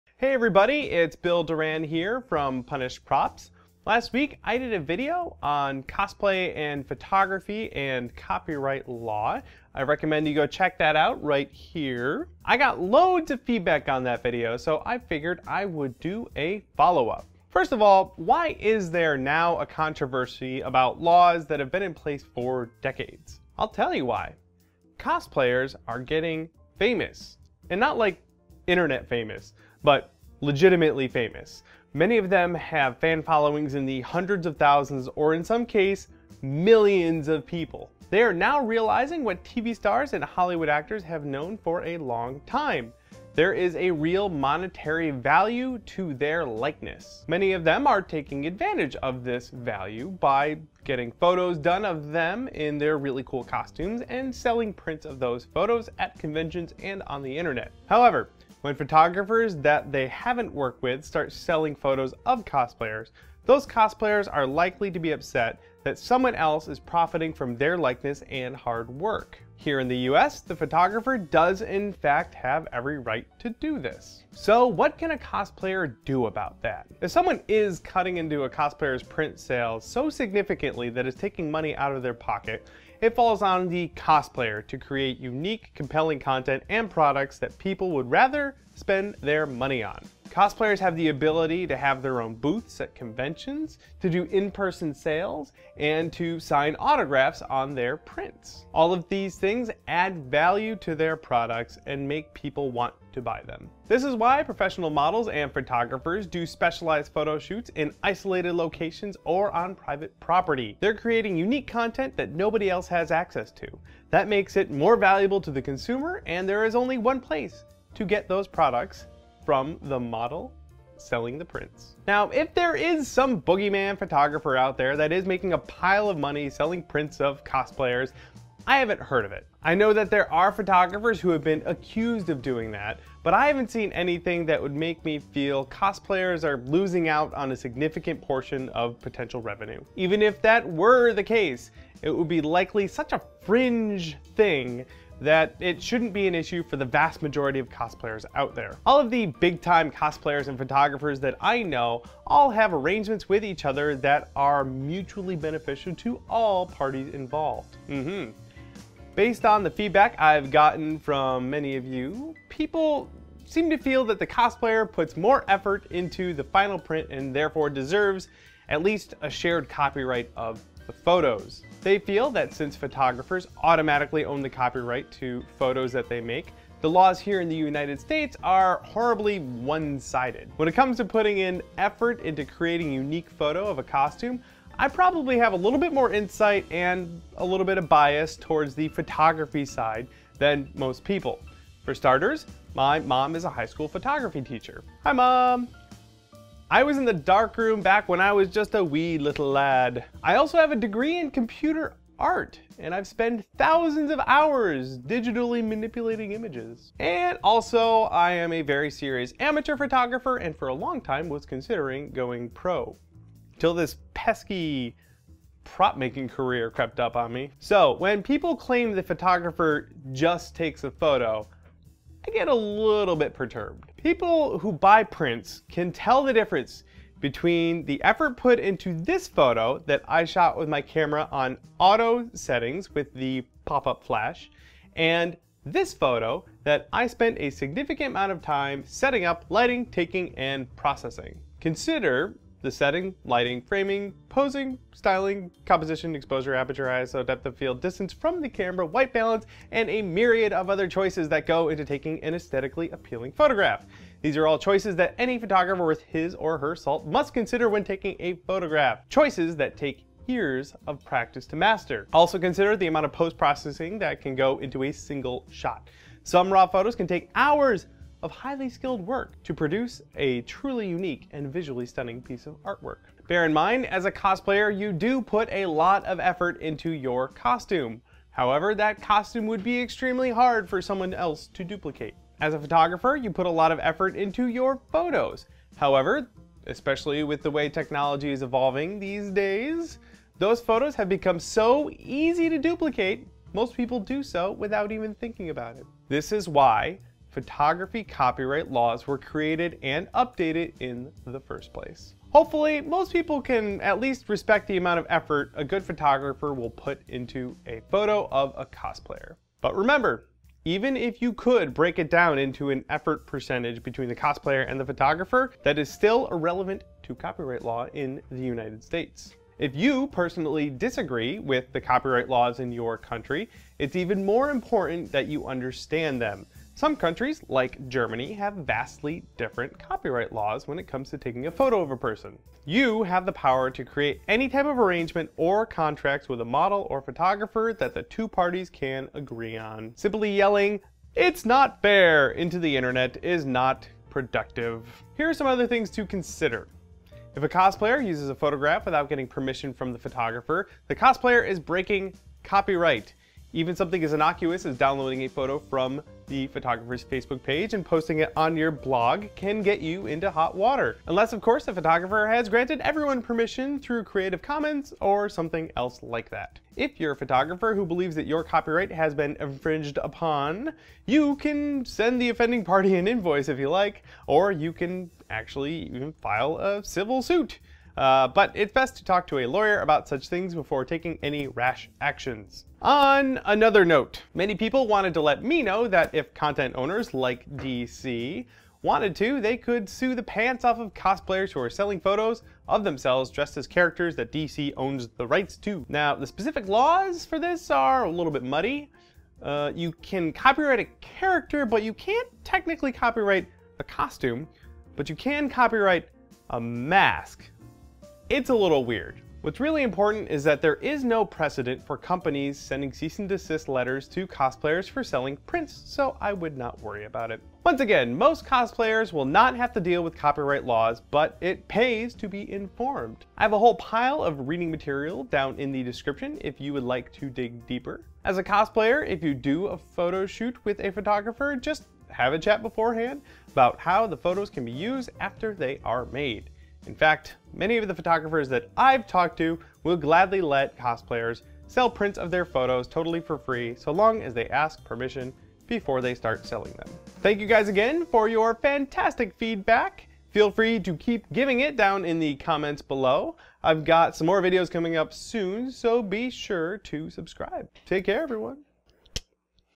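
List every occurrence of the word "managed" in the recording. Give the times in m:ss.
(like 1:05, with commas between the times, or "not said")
not said.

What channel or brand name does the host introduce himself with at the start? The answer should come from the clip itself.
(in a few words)
Punished Props.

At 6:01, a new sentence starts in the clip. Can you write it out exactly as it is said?
Unless, of course, the photographer has granted everyone permission through Creative Commons or something else like that.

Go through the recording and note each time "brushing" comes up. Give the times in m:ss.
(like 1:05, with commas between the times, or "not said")
not said.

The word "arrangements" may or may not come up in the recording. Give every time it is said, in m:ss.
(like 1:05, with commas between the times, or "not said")
2:32, 5:34.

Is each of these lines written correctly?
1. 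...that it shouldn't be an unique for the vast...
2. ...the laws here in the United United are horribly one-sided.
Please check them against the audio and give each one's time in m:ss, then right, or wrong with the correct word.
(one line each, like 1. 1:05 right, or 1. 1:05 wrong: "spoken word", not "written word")
1. 2:25 wrong: "issue", not "unique"
2. 2:56 wrong: "States", not "United".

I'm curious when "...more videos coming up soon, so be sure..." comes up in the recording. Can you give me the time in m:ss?
7:34.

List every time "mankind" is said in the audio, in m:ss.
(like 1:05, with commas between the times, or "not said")
not said.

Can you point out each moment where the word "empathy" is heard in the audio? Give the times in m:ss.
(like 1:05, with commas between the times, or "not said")
not said.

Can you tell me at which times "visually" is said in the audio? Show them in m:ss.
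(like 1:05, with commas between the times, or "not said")
4:31.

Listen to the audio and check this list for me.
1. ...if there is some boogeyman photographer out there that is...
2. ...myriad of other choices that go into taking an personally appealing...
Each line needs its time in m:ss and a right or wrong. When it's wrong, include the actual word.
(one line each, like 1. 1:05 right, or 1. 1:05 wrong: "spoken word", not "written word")
1. 2:02 right
2. 4:10 wrong: "aesthetically", not "personally".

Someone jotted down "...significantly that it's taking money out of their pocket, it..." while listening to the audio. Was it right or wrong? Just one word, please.
right.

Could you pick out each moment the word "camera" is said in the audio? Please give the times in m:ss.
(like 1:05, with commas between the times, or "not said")
3:50, 4:08.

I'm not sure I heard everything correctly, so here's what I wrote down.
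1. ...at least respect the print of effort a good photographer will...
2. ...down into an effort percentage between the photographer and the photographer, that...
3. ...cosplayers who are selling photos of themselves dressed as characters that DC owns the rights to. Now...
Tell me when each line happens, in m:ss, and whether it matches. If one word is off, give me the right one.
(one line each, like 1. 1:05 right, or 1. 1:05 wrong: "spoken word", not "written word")
1. 5:03 wrong: "amount", not "print"
2. 5:12 wrong: "cosplayer", not "photographer"
3. 6:30 right.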